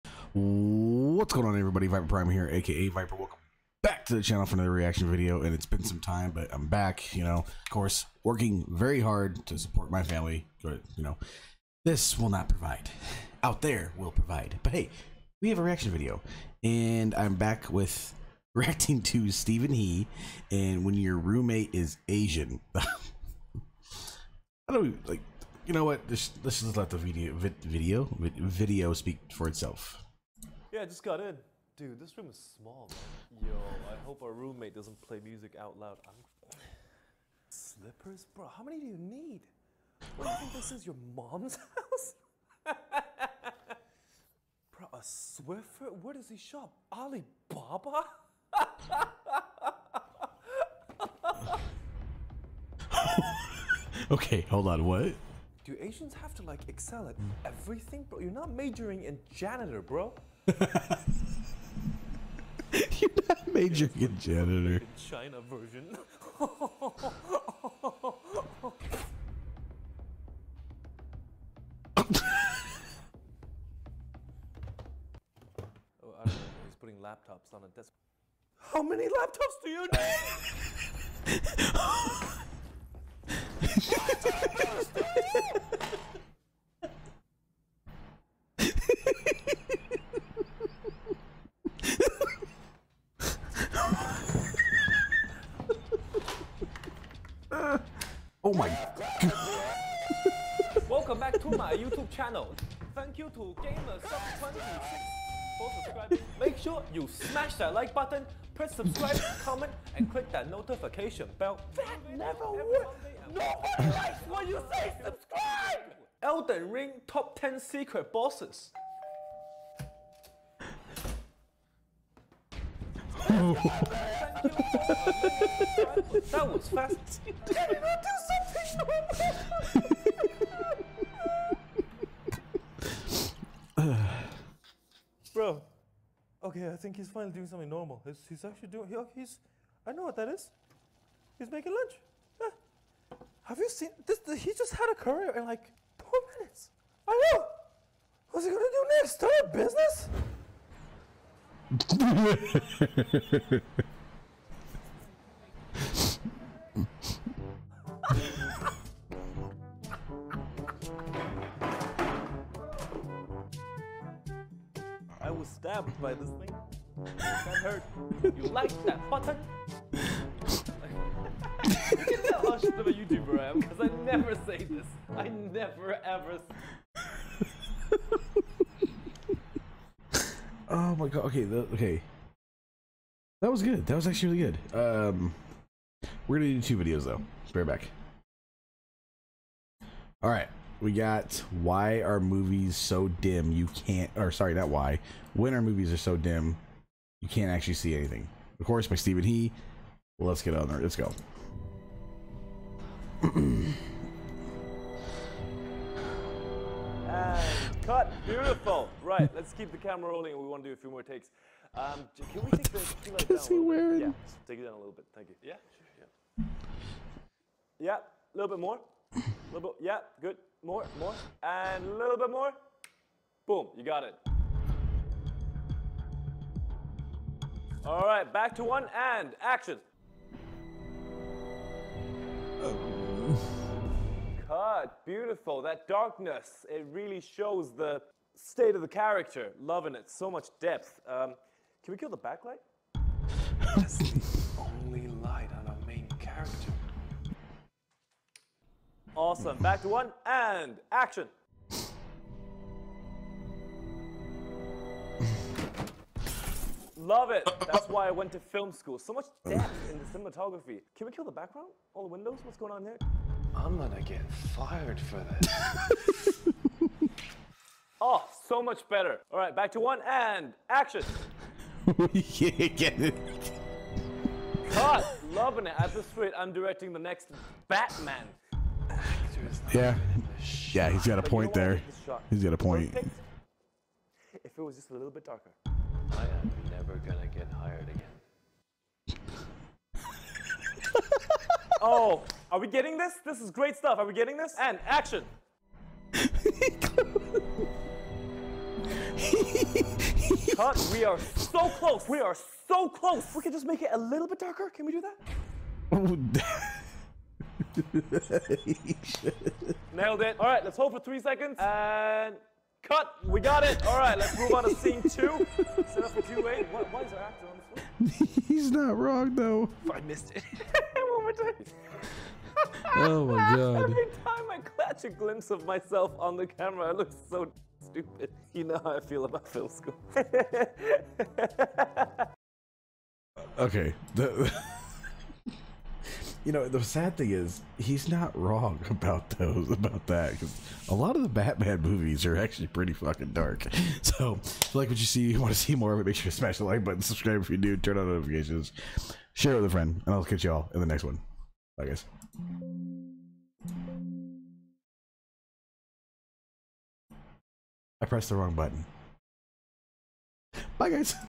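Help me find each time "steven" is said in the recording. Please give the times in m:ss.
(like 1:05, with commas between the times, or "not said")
0:19, 3:18.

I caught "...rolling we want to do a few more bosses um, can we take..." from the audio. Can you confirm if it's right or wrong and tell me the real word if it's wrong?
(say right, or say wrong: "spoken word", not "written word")
wrong: "takes", not "bosses".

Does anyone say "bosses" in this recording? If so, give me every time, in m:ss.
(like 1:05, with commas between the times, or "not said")
1:58.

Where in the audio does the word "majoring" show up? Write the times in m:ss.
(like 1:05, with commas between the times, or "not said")
0:58, 1:03.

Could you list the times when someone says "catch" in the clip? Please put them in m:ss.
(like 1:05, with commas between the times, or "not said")
5:24, 5:50.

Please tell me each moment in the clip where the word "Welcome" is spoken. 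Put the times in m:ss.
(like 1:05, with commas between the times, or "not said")
0:03, 1:40.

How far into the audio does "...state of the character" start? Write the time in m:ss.
3:58.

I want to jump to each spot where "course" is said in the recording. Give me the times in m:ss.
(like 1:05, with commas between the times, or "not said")
0:07, 3:18.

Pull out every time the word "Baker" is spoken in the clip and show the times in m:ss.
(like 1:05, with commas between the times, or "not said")
not said.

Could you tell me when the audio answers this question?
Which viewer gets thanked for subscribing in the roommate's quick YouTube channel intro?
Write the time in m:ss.
1:43.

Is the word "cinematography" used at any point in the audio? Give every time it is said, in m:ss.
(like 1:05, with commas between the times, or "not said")
4:20.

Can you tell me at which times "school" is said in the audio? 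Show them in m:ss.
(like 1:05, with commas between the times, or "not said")
4:18, 5:29.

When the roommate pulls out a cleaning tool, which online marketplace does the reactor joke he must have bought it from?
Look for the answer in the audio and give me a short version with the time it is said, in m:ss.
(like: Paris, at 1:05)
Alibaba, at 0:46.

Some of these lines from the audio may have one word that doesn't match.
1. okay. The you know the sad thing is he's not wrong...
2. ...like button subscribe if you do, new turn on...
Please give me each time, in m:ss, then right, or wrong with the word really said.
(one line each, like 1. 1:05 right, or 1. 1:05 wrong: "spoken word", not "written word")
1. 5:33 right
2. 5:46 right.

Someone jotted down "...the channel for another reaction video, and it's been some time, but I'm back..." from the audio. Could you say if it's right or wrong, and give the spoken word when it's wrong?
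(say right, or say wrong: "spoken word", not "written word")
right.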